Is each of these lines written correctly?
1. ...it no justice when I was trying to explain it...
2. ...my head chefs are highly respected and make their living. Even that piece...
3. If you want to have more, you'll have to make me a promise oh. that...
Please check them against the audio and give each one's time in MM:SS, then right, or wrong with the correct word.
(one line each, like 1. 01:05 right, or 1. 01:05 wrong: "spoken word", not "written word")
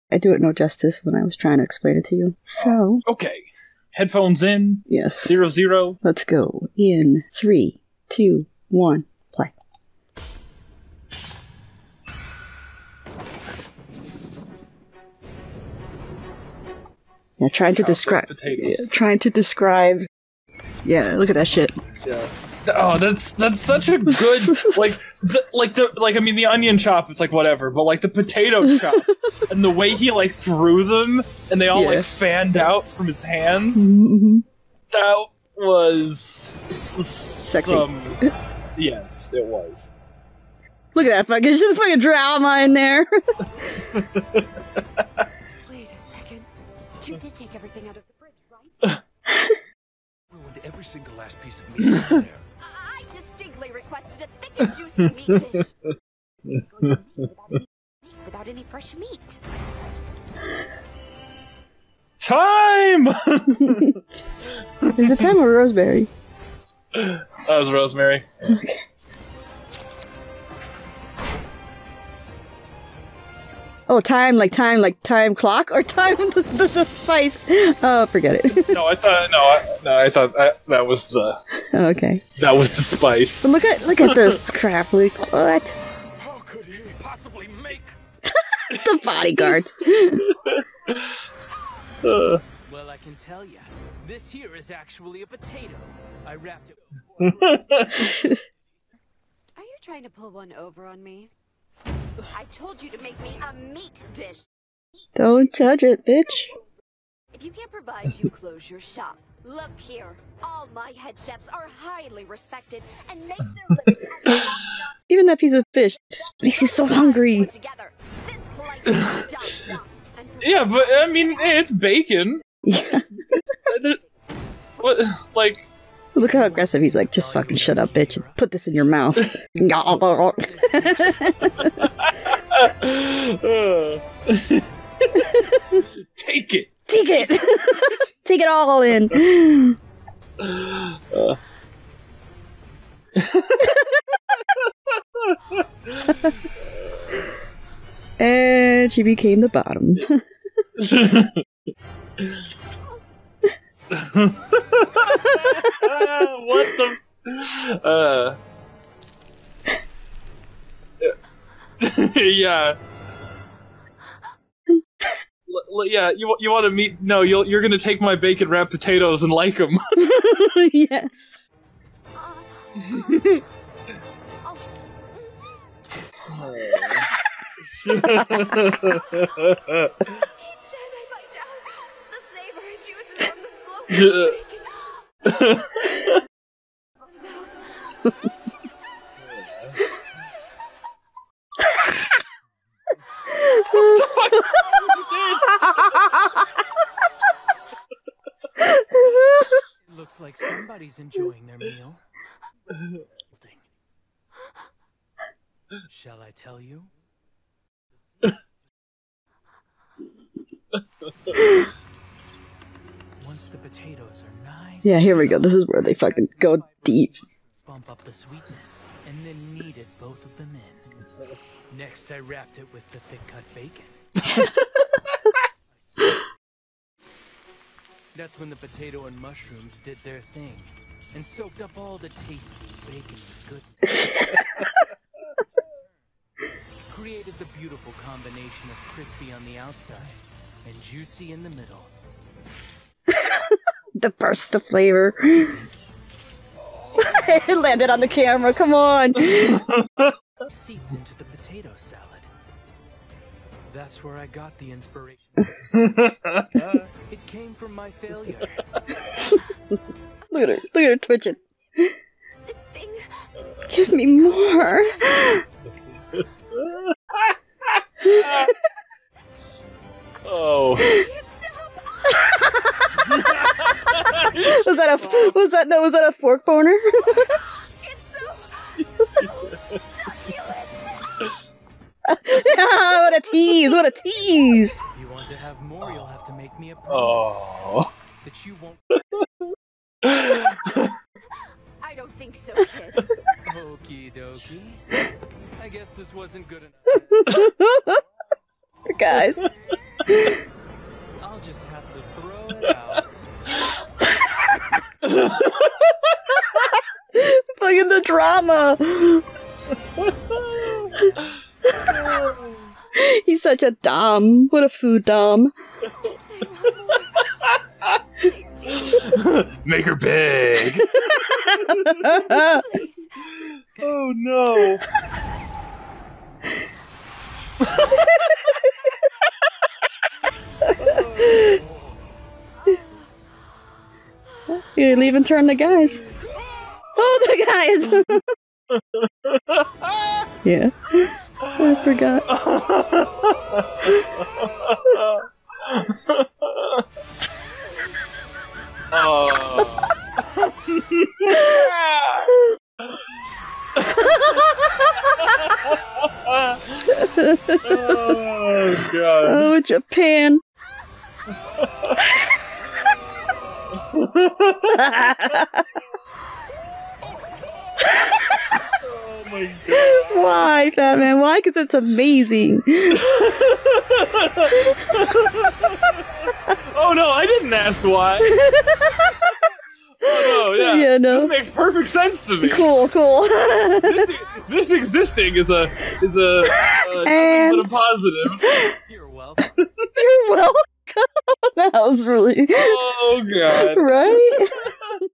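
1. 00:00 right
2. 01:50 right
3. 04:44 right.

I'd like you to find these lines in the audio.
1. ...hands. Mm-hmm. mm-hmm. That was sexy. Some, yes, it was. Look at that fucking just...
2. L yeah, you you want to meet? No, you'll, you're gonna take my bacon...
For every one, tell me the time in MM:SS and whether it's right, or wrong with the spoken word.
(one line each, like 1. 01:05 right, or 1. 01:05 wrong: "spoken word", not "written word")
1. 00:33 right
2. 02:45 right.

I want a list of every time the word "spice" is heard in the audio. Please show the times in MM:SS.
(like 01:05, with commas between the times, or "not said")
01:16, 01:22.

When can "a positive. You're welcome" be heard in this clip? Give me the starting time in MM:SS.
06:27.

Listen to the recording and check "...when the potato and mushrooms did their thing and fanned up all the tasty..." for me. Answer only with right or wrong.
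wrong.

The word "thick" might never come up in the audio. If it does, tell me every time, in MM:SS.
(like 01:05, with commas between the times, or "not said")
00:54, 03:42.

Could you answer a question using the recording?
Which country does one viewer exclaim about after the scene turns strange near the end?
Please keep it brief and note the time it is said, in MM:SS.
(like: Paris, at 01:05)
Japan, at 05:59.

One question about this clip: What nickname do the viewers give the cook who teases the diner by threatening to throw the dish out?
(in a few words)
food dom.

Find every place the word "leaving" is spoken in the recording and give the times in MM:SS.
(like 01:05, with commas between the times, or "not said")
05:34.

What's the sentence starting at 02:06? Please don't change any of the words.
Look how aggressive he's like, just fucking shut up, bitch, put this in your mouth.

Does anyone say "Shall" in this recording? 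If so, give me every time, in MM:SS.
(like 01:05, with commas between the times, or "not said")
03:25.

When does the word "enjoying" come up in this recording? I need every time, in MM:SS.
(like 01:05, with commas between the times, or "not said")
03:20.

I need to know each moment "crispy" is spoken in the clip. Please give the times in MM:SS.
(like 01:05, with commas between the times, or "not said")
03:58.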